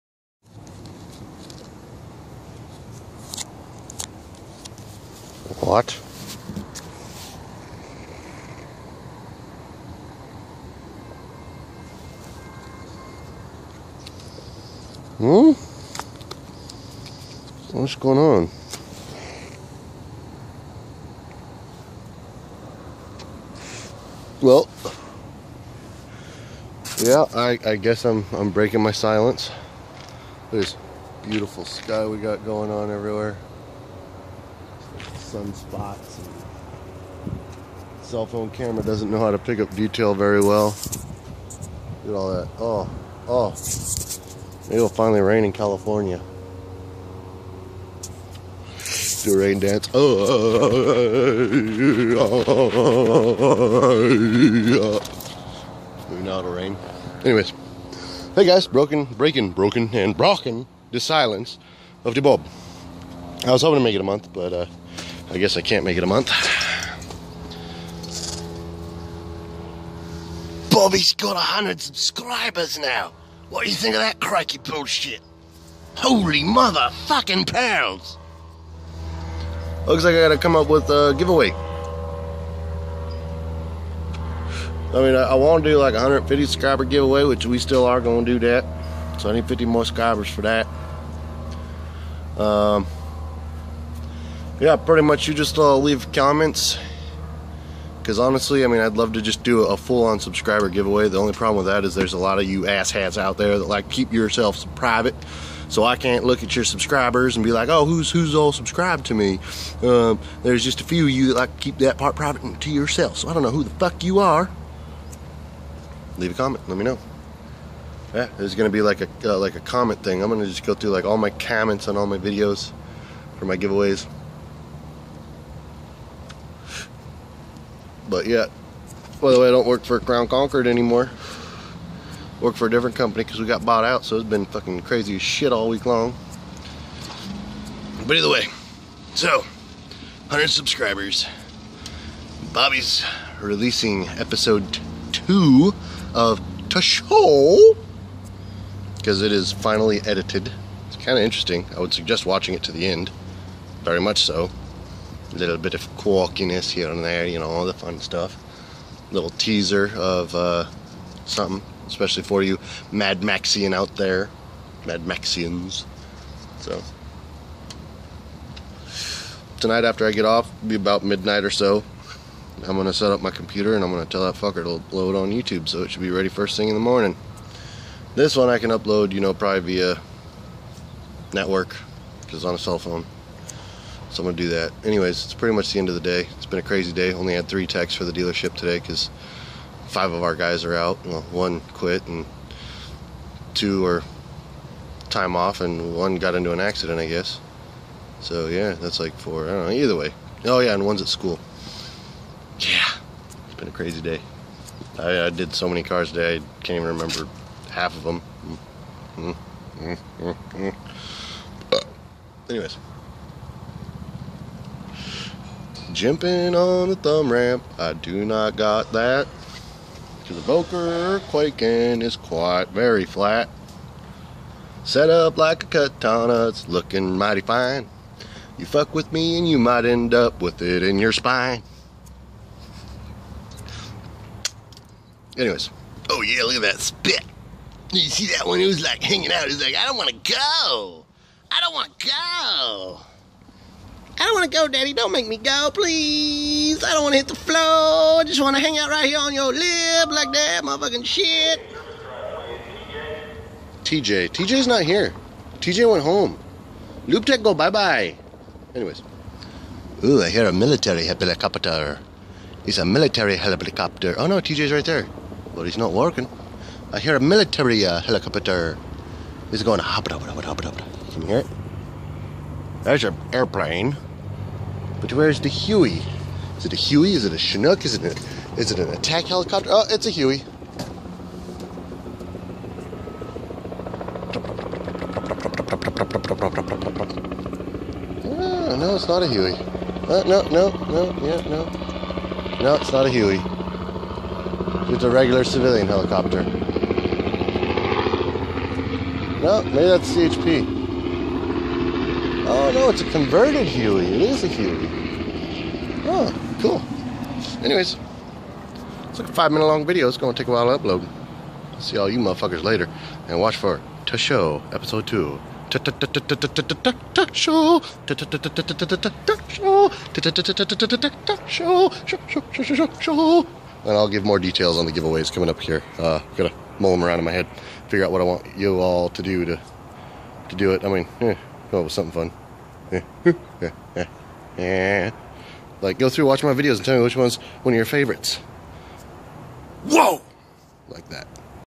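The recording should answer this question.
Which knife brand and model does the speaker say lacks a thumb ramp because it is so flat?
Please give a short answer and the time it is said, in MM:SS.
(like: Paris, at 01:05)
Boker Kwaiken, at 03:40.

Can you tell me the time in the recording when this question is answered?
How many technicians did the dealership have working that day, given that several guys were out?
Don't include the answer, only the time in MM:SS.
03:07.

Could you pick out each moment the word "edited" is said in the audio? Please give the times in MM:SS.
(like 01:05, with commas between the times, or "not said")
02:30.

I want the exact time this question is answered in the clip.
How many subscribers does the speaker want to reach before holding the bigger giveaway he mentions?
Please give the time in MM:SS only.
01:25.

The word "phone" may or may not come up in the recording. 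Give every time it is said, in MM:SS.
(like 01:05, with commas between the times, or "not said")
00:38, 03:02.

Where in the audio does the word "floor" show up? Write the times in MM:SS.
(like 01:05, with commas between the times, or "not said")
04:07.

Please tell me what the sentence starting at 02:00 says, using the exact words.
I'm gonna just go through like all my comments on all my videos for my giveaways.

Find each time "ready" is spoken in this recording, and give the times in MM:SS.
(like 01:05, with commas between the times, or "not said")
02:56.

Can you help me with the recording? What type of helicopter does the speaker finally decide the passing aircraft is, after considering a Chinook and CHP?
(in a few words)
Converted Huey.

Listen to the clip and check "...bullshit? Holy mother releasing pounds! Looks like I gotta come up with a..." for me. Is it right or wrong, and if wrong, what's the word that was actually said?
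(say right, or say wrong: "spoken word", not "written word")
wrong: "fucking", not "releasing".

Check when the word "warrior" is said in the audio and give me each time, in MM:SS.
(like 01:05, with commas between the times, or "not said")
not said.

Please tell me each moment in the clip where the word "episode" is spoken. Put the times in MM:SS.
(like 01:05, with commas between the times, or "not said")
02:24, 05:14.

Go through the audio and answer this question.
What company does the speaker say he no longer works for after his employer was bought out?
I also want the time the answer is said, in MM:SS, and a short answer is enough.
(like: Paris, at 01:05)
Crown Concord, at 02:10.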